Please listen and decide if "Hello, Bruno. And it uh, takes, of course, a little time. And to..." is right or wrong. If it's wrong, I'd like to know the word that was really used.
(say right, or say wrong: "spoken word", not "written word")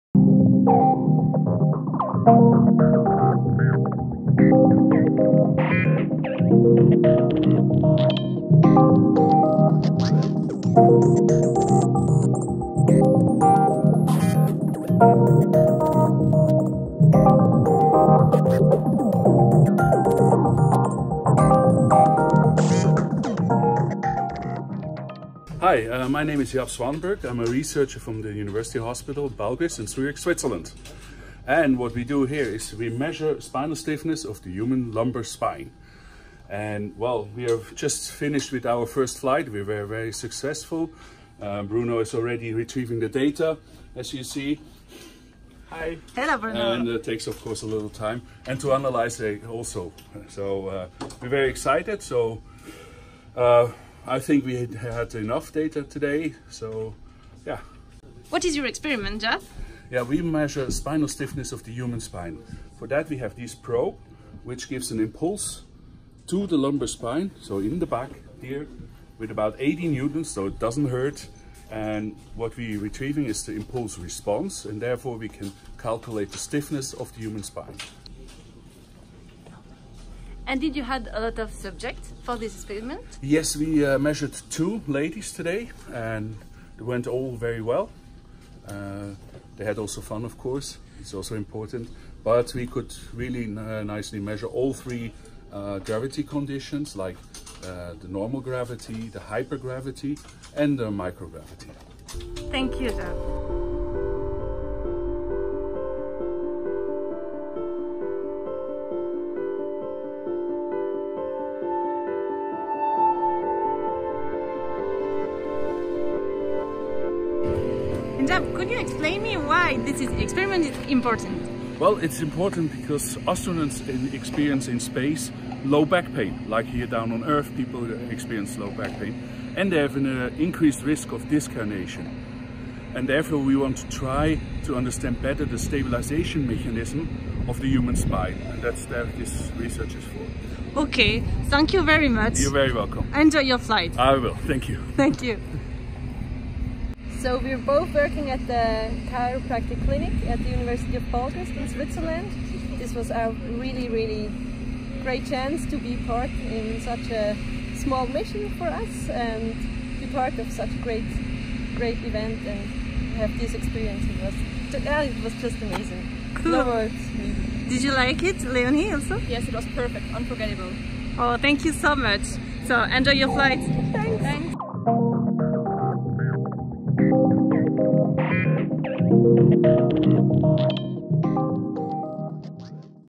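right.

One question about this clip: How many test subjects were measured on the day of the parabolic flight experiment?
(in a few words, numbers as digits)
2.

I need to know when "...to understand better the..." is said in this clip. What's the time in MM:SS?
02:14.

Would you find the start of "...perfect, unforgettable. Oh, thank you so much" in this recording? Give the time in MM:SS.
02:49.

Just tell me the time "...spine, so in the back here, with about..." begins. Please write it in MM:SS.
01:06.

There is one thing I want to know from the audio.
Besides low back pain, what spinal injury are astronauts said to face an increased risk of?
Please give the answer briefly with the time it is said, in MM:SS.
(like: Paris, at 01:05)
Disc herniation, at 02:11.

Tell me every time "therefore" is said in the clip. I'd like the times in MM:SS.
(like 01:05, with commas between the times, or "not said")
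01:14, 02:13.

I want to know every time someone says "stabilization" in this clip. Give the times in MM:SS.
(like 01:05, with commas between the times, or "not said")
02:15.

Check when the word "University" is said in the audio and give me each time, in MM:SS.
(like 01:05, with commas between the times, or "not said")
00:28, 02:30.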